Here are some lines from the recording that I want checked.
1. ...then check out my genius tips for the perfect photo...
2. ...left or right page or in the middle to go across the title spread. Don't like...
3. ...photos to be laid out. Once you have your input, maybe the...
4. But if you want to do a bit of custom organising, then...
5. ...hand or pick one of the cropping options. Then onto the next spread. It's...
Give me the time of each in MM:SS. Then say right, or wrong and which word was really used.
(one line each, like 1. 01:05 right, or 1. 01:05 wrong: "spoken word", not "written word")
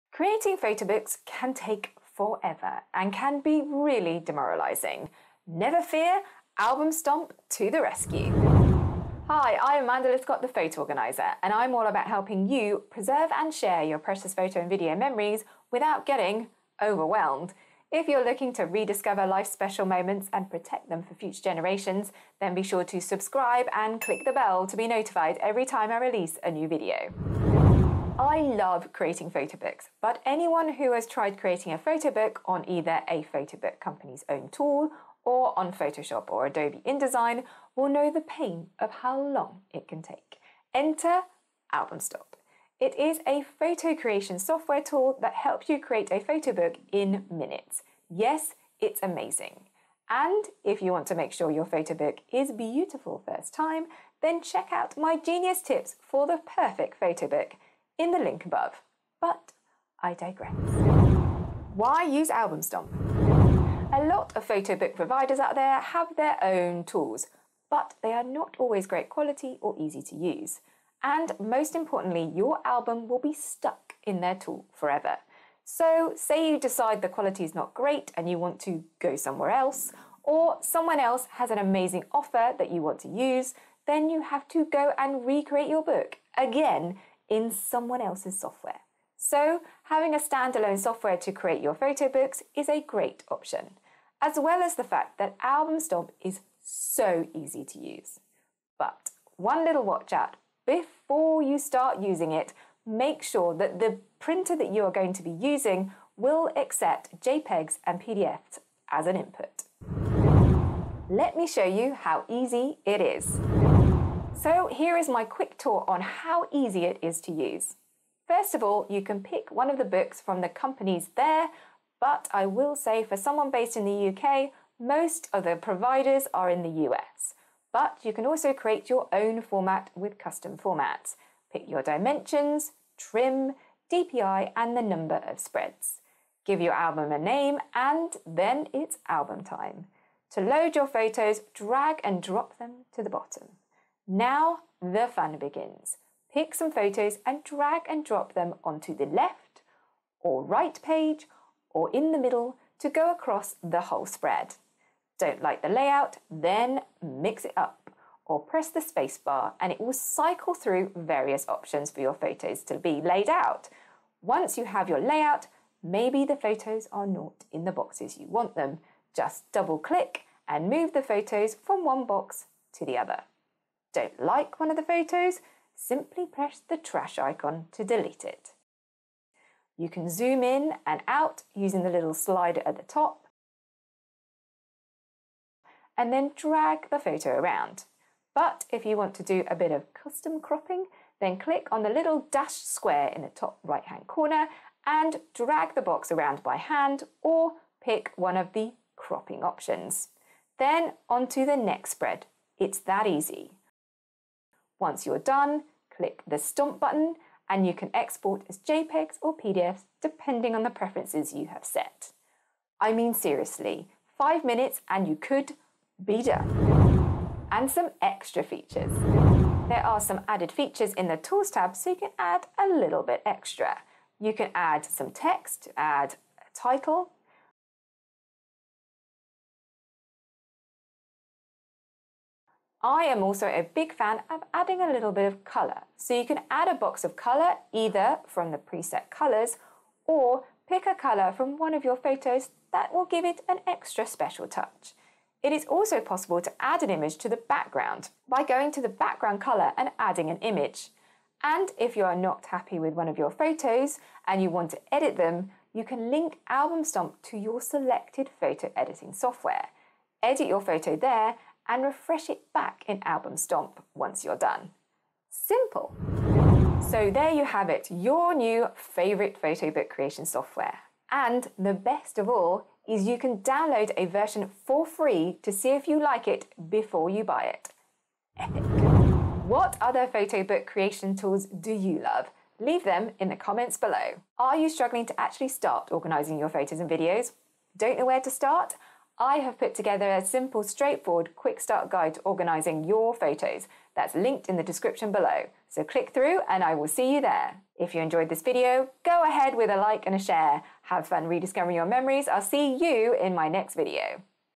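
1. 00:54 right
2. 02:29 wrong: "whole", not "title"
3. 02:42 wrong: "layout", not "input"
4. 03:08 wrong: "cropping", not "organising"
5. 03:16 right.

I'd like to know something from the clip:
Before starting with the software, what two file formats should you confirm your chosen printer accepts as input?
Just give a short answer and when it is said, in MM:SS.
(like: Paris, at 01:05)
JPEGs and PDFs, at 01:47.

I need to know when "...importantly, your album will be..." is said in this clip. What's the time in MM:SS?
01:11.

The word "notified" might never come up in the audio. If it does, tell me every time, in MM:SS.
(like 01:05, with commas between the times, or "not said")
00:24.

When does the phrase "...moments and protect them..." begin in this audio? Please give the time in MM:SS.
00:19.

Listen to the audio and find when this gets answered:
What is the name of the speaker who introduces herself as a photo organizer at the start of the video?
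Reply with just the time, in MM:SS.
00:09.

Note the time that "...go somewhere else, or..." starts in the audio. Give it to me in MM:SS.
01:18.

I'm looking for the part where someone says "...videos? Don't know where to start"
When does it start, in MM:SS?
04:46.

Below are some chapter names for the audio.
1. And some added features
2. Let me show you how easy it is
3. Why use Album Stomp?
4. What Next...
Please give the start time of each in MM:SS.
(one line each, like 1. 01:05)
1. 03:37
2. 01:50
3. 00:58
4. 04:38.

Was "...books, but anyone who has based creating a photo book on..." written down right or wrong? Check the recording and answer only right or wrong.
wrong.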